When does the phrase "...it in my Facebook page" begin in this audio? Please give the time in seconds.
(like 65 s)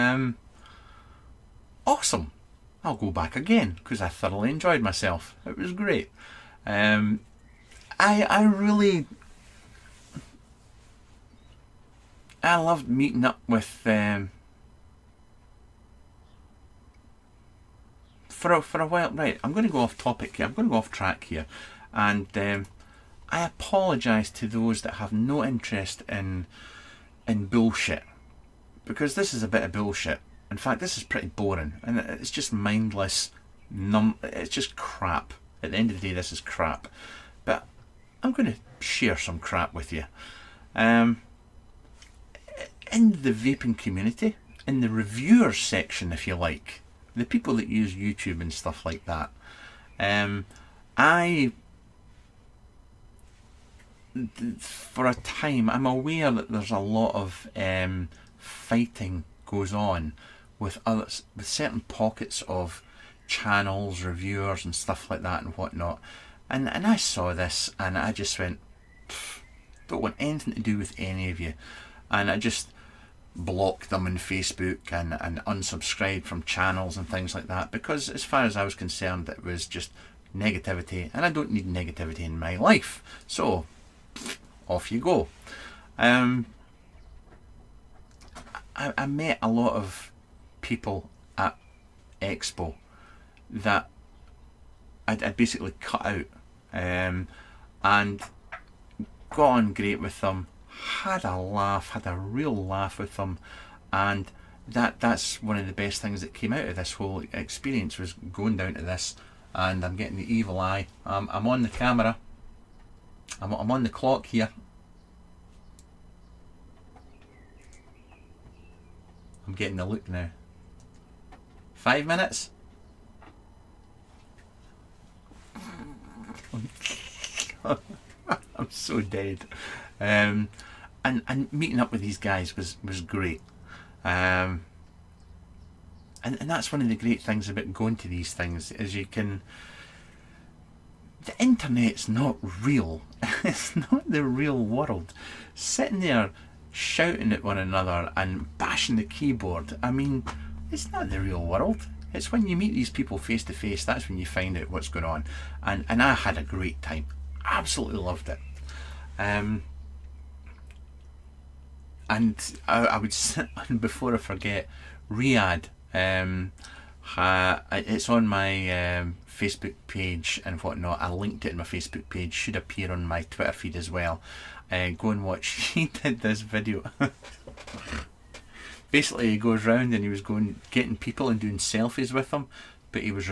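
171 s.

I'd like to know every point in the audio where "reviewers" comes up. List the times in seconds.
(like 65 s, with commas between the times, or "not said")
44 s, 64 s.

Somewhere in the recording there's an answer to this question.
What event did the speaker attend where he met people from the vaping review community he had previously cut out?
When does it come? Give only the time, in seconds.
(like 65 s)
92 s.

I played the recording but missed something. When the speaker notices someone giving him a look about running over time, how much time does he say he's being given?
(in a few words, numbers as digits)
5 minutes.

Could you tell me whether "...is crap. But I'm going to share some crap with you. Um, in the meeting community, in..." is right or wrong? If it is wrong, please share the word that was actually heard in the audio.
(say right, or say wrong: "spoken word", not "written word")
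wrong: "vaping", not "meeting".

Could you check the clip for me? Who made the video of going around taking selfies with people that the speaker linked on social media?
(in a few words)
Riyadh.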